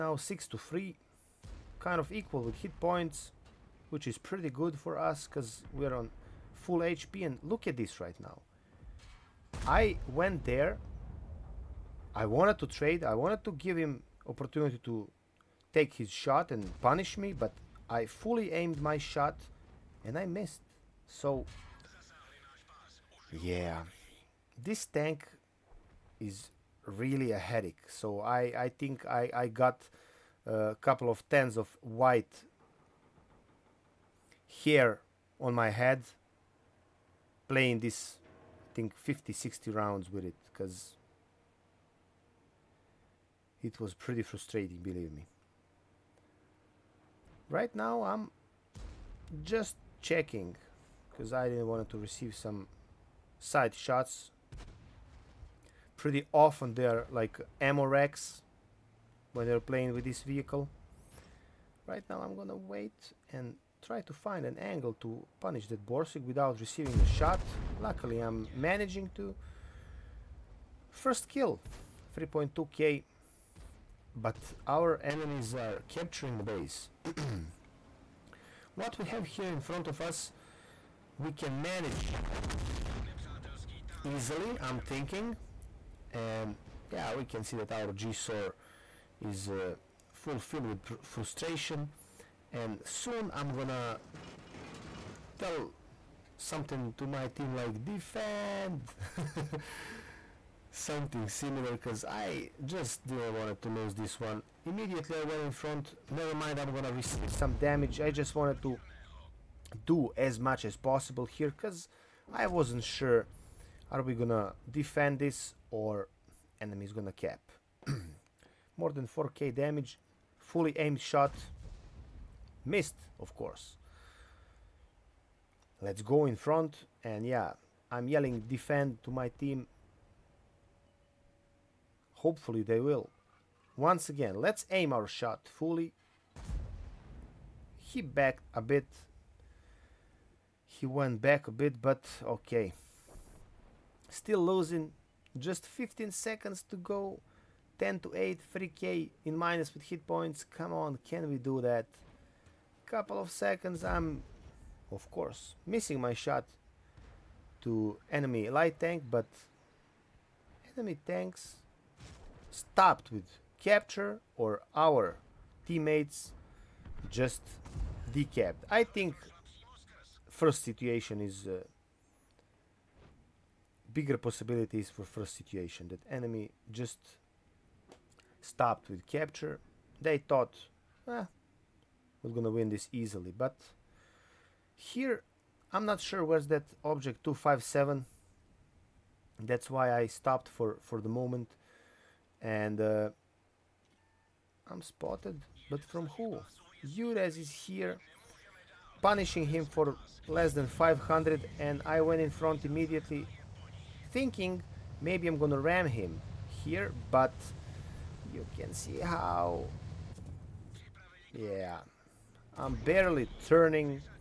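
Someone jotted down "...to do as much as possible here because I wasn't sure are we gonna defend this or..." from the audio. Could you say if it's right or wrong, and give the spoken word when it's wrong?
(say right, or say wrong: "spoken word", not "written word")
right.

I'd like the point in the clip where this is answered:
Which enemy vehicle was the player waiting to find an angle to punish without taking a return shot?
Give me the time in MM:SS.
01:05.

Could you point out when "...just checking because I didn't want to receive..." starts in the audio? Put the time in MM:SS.
00:49.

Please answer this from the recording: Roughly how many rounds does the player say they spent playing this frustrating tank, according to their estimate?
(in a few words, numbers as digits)
50-60.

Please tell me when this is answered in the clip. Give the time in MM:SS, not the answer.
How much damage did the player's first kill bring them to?
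01:12.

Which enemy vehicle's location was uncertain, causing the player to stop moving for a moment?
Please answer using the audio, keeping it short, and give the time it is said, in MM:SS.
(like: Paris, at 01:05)
Object 257, at 03:06.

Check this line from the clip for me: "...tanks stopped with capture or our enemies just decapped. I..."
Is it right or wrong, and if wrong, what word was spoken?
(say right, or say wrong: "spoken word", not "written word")
wrong: "teammates", not "enemies".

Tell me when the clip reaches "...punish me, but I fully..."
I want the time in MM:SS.
00:16.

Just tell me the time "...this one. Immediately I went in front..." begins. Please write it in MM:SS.
01:43.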